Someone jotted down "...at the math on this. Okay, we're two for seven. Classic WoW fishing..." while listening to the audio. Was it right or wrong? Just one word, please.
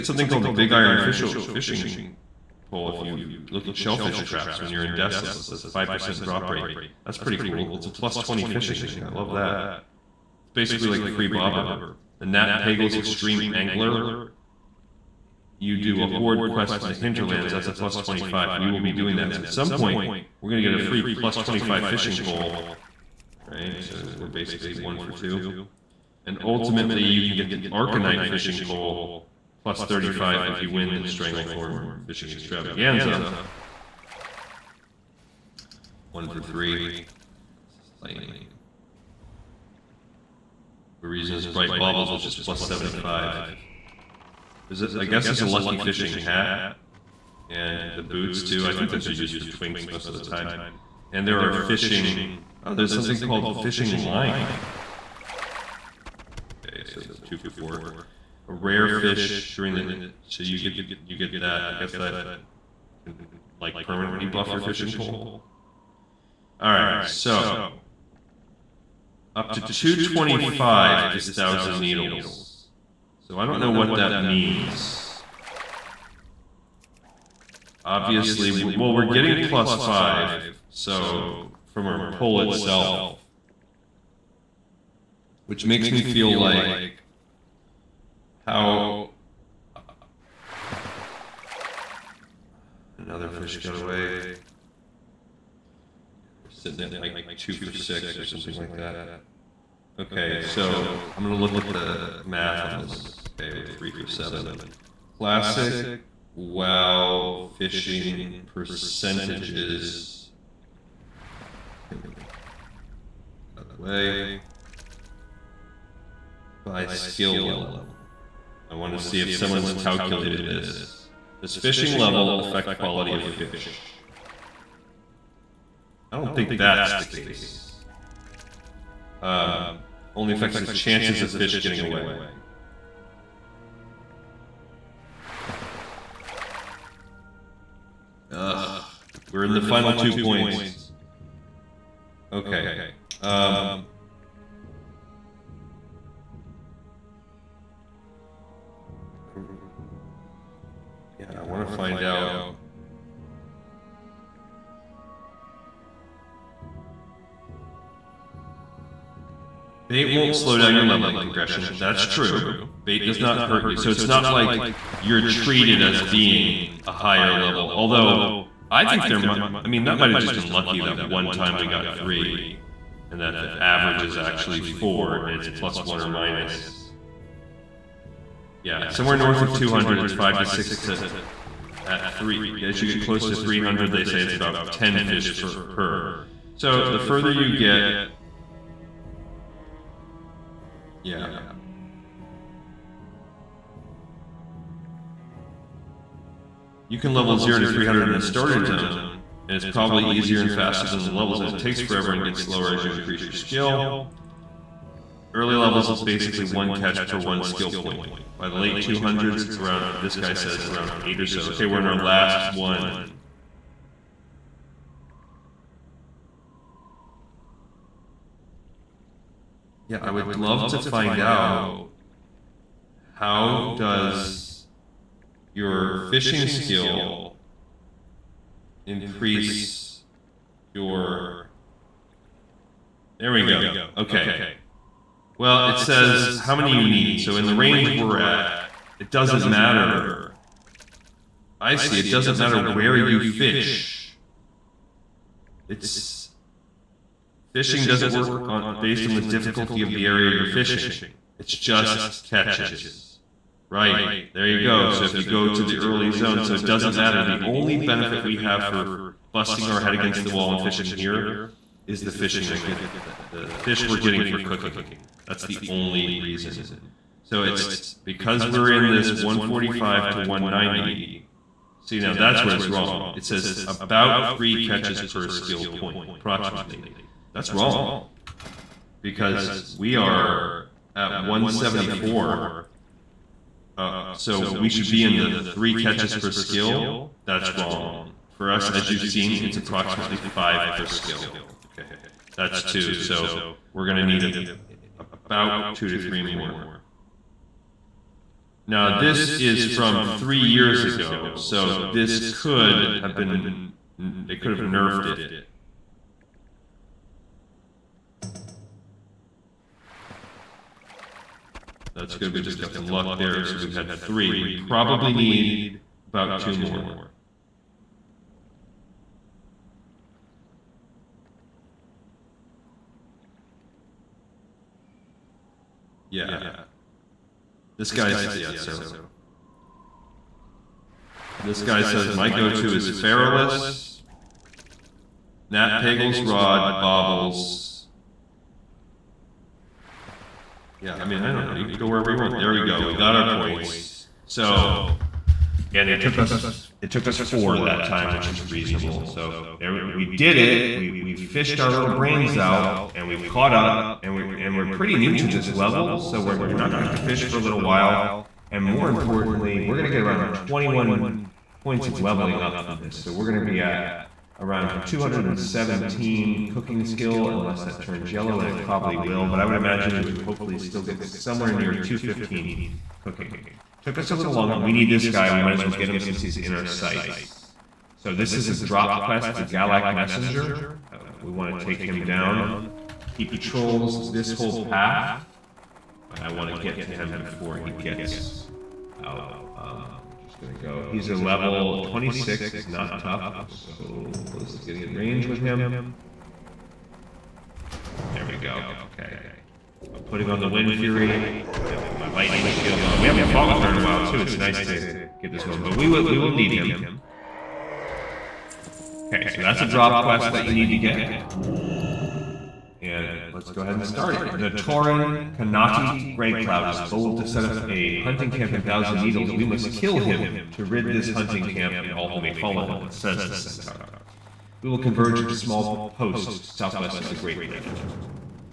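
wrong.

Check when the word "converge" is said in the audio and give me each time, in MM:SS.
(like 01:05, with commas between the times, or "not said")
07:04.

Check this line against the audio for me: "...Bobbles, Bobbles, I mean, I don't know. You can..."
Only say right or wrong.
wrong.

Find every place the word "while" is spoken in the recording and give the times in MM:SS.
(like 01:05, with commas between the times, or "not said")
05:57, 06:43.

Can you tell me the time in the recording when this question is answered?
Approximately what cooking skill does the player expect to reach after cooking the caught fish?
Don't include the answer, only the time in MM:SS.
06:04.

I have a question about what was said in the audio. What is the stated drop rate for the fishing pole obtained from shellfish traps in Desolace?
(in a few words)
5%.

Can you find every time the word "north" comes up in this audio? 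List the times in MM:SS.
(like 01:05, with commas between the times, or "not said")
02:59.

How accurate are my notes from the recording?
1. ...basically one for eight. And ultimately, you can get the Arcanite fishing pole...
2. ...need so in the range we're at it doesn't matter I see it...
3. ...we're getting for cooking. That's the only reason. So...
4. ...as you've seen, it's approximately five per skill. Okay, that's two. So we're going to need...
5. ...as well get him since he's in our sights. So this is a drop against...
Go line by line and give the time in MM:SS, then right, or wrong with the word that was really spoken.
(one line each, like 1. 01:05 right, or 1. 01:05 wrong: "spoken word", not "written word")
1. 00:24 wrong: "two", not "eight"
2. 03:56 right
3. 04:23 right
4. 04:48 right
5. 06:15 wrong: "quest", not "against".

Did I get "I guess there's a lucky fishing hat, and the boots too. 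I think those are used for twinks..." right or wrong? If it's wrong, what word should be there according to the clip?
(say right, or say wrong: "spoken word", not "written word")
right.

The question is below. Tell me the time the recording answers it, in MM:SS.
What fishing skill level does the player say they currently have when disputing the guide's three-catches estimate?
04:41.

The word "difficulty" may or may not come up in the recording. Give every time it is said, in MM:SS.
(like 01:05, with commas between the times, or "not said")
04:09.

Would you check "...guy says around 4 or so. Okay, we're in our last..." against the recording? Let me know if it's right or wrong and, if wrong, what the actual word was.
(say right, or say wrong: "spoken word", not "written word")
wrong: "8", not "4".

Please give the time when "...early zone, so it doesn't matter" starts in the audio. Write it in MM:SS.
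04:15.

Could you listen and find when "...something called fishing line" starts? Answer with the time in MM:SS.
00:52.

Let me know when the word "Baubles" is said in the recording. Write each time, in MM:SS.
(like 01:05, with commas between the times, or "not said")
00:41.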